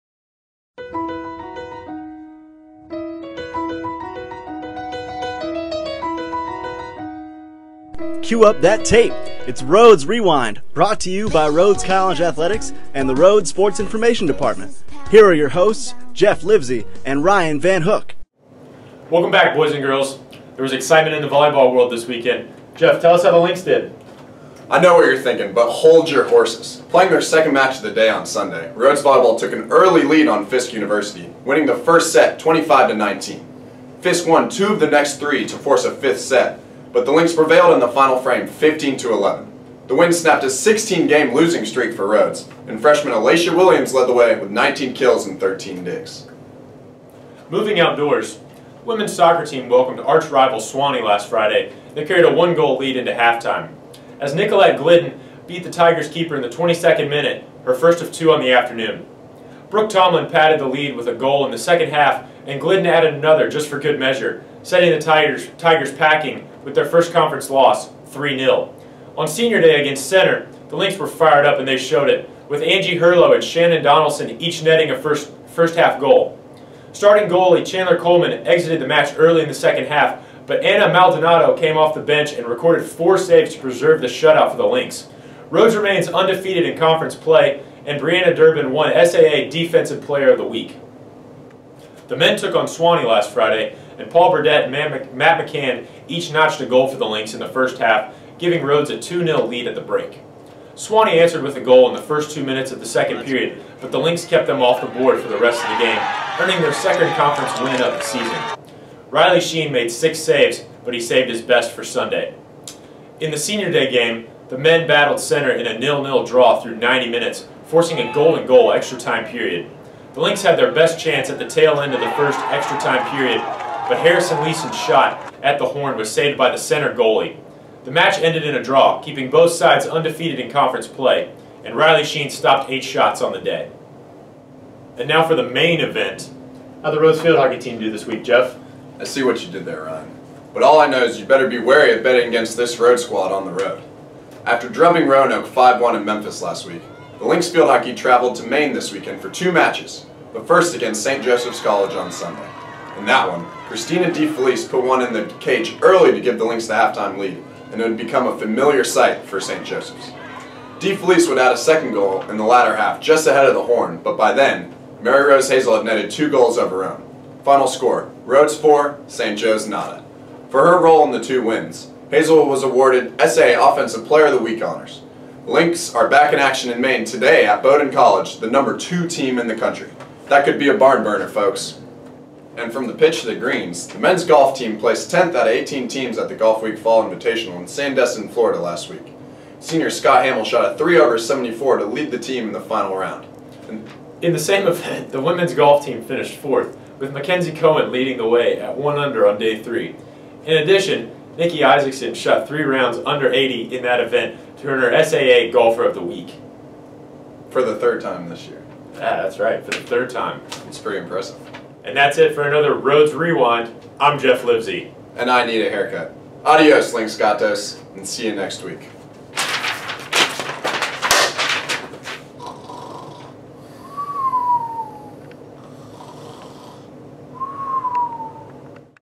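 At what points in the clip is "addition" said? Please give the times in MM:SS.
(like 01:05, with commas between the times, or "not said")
03:20.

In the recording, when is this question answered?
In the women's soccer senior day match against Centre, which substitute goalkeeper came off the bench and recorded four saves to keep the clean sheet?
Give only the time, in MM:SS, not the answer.
01:20.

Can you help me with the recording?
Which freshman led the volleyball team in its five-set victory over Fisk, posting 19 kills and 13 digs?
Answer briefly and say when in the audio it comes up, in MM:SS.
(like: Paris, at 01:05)
Alacia Williams, at 00:43.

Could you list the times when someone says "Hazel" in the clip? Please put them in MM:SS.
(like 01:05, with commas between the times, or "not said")
02:45, 02:52.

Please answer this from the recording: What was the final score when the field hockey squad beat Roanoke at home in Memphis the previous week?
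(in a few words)
5-1.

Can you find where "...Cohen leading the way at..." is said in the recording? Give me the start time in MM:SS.
03:17.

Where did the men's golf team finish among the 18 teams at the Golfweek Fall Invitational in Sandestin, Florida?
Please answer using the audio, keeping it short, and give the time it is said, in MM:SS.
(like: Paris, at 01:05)
10th, at 03:05.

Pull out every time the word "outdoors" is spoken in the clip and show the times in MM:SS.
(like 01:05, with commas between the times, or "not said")
00:47.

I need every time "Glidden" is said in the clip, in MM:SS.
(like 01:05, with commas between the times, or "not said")
00:54, 01:02.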